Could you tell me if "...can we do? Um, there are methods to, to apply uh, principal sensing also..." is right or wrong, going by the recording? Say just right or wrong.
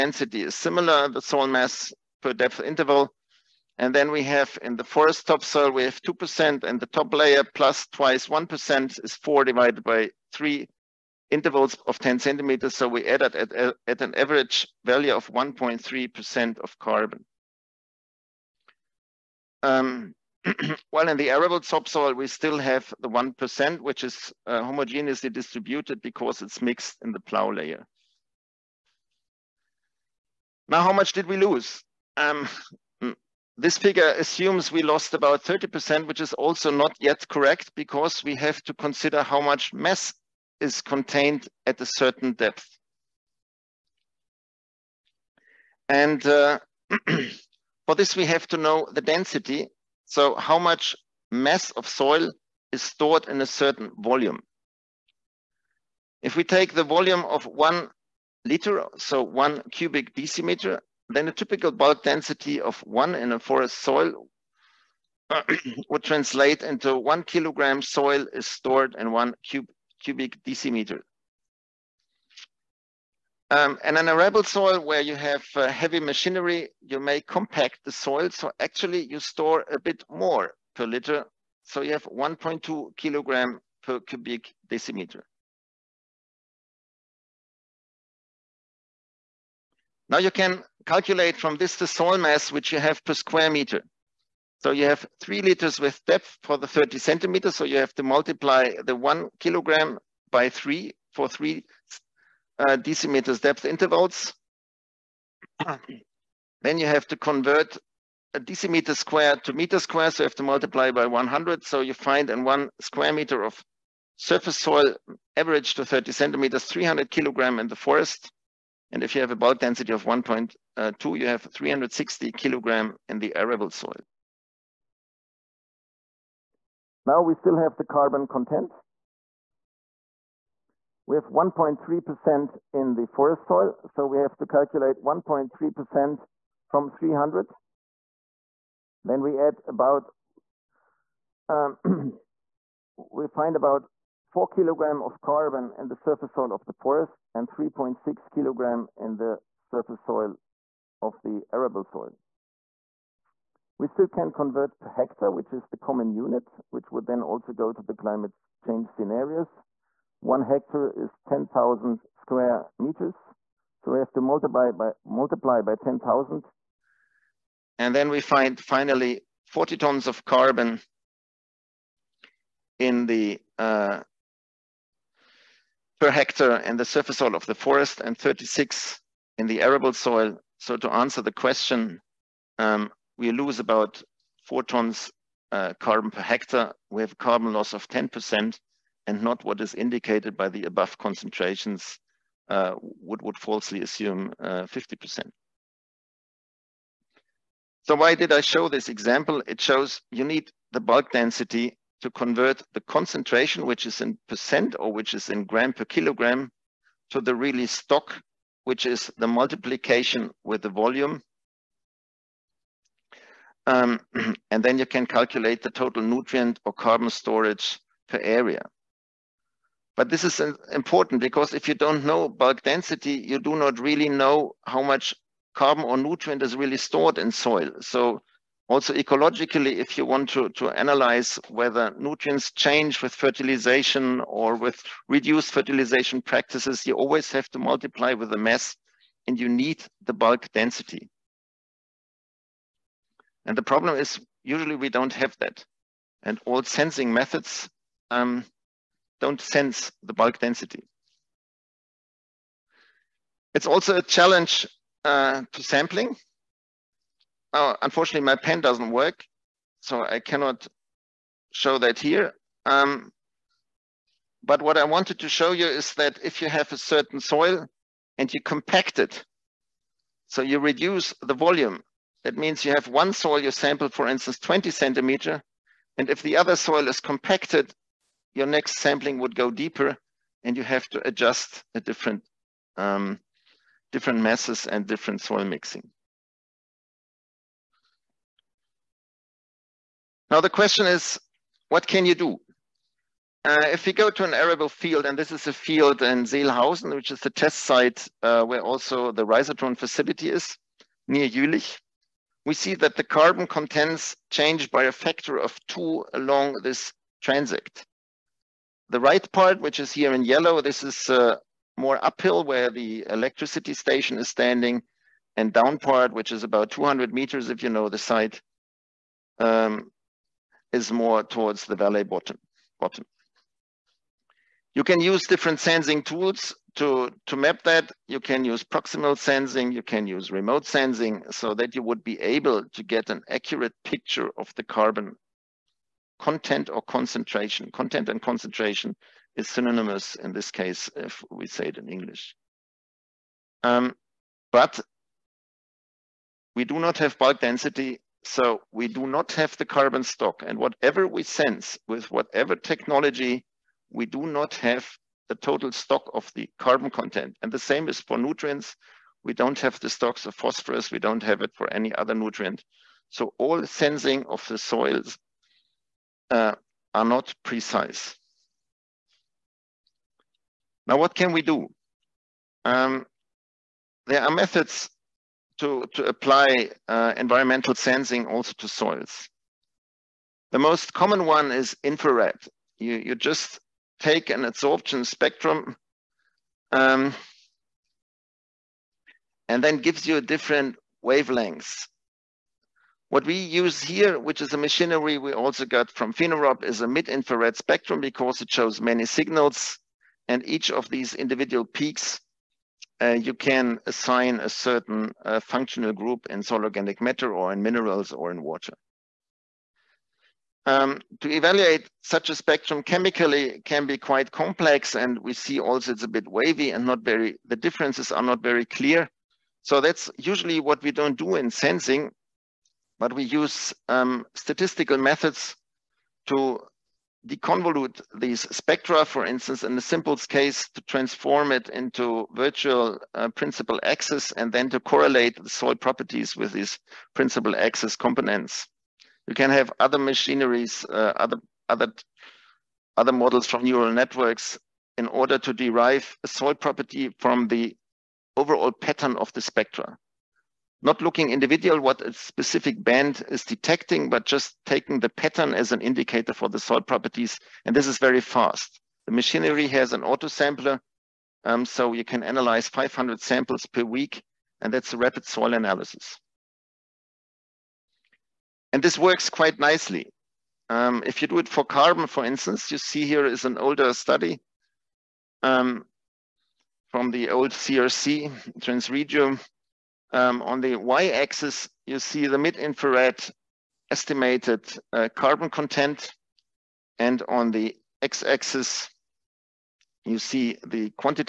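wrong.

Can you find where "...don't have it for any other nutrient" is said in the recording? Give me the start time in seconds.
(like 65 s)
360 s.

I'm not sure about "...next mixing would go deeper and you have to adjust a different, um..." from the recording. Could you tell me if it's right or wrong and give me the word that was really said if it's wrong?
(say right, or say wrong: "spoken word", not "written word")
wrong: "sampling", not "mixing".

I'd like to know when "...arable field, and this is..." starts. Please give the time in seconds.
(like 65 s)
294 s.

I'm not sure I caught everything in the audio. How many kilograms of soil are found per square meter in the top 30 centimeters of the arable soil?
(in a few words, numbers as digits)
360.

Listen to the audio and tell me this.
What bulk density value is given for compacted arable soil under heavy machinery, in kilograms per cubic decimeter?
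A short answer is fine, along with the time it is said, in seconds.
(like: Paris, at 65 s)
1.2, at 82 s.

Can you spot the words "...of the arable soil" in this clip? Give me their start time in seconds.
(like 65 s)
151 s.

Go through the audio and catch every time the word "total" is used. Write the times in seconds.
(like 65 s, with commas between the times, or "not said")
215 s, 355 s.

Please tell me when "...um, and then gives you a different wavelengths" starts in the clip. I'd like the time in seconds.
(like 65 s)
386 s.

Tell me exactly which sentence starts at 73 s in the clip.
Um, and an arable soil where you have uh, heavy machinery, you may compact the soil.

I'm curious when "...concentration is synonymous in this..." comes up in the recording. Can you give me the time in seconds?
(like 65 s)
338 s.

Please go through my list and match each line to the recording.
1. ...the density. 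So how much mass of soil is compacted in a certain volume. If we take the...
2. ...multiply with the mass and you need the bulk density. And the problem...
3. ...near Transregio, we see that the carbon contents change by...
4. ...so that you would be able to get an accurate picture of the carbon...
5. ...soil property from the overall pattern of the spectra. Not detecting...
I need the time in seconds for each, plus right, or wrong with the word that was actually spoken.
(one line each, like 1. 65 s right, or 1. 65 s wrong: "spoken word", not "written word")
1. 48 s wrong: "stored", not "compacted"
2. 237 s right
3. 301 s wrong: "Jülich", not "Transregio"
4. 331 s right
5. 446 s wrong: "looking", not "detecting".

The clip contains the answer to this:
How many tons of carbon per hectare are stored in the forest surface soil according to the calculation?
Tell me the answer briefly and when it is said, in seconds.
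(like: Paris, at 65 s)
40, at 169 s.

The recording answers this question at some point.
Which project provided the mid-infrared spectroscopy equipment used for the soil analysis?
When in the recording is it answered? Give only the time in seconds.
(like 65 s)
396 s.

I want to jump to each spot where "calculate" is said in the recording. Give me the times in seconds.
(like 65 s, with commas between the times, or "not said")
90 s, 134 s, 215 s.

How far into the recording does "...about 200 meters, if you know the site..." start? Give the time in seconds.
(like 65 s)
316 s.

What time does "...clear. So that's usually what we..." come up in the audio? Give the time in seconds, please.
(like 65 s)
418 s.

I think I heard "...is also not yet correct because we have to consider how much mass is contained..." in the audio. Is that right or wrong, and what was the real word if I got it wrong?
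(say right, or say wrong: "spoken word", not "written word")
right.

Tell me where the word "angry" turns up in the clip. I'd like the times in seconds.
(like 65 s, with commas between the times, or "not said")
not said.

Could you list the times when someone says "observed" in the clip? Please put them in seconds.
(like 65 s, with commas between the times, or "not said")
not said.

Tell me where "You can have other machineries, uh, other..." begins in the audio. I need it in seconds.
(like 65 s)
439 s.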